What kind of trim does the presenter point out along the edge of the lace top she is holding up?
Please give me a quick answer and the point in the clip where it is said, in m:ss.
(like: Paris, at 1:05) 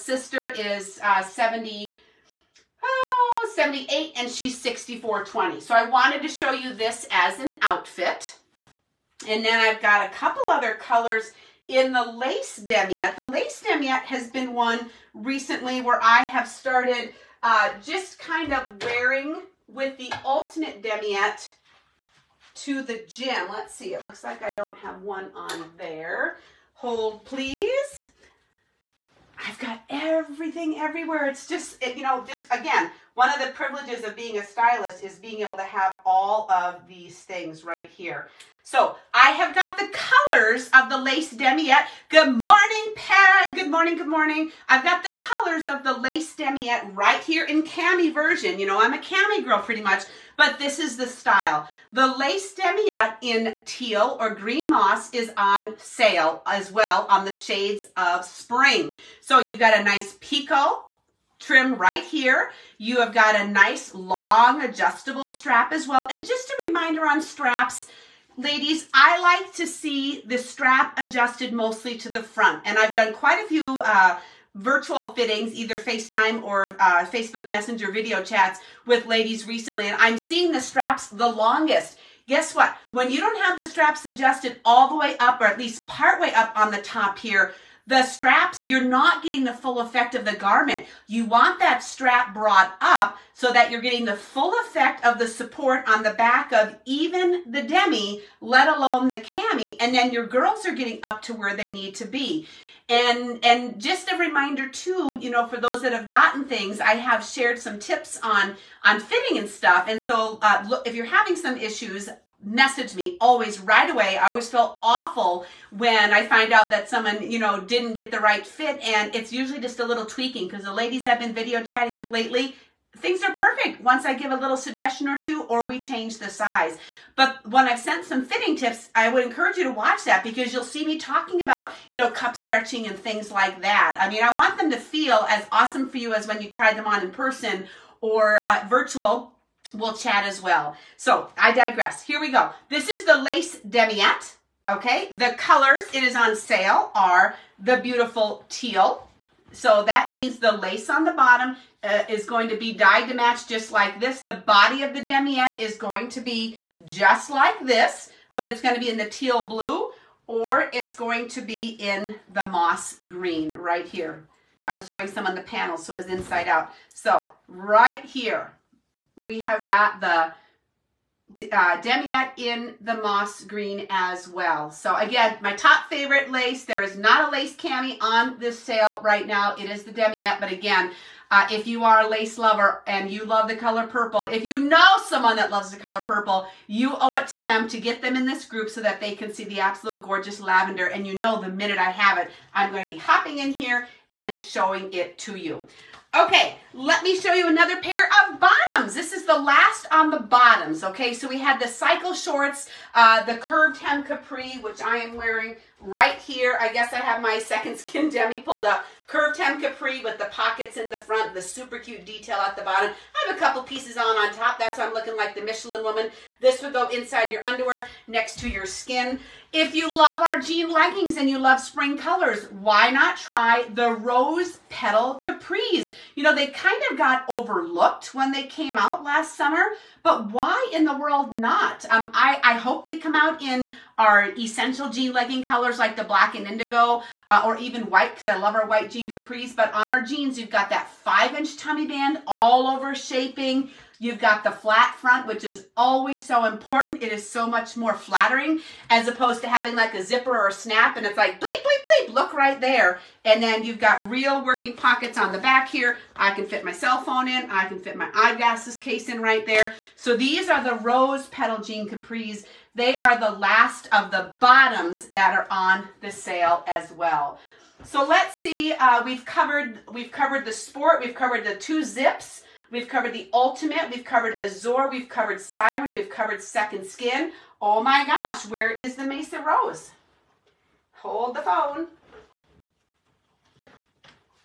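picot, at 1:00.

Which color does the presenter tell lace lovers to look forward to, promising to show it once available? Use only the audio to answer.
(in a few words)
lavender.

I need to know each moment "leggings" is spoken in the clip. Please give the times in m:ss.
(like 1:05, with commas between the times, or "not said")
3:40, 3:55.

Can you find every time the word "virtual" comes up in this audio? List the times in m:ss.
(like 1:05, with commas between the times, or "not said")
1:14, 2:18.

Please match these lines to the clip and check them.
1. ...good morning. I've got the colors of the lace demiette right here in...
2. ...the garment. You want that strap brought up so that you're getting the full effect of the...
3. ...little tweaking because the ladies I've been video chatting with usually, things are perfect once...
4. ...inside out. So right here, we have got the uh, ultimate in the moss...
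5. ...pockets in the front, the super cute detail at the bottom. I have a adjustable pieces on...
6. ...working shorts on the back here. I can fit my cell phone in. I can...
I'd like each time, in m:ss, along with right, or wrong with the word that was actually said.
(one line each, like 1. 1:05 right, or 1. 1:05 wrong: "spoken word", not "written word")
1. 0:43 right
2. 1:30 right
3. 1:59 wrong: "lately", not "usually"
4. 2:46 wrong: "demiette", not "ultimate"
5. 3:30 wrong: "couple", not "adjustable"
6. 4:14 wrong: "pockets", not "shorts".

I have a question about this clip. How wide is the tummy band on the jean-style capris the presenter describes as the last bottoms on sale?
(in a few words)
5 inches.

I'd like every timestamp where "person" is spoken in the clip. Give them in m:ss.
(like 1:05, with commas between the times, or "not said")
2:17.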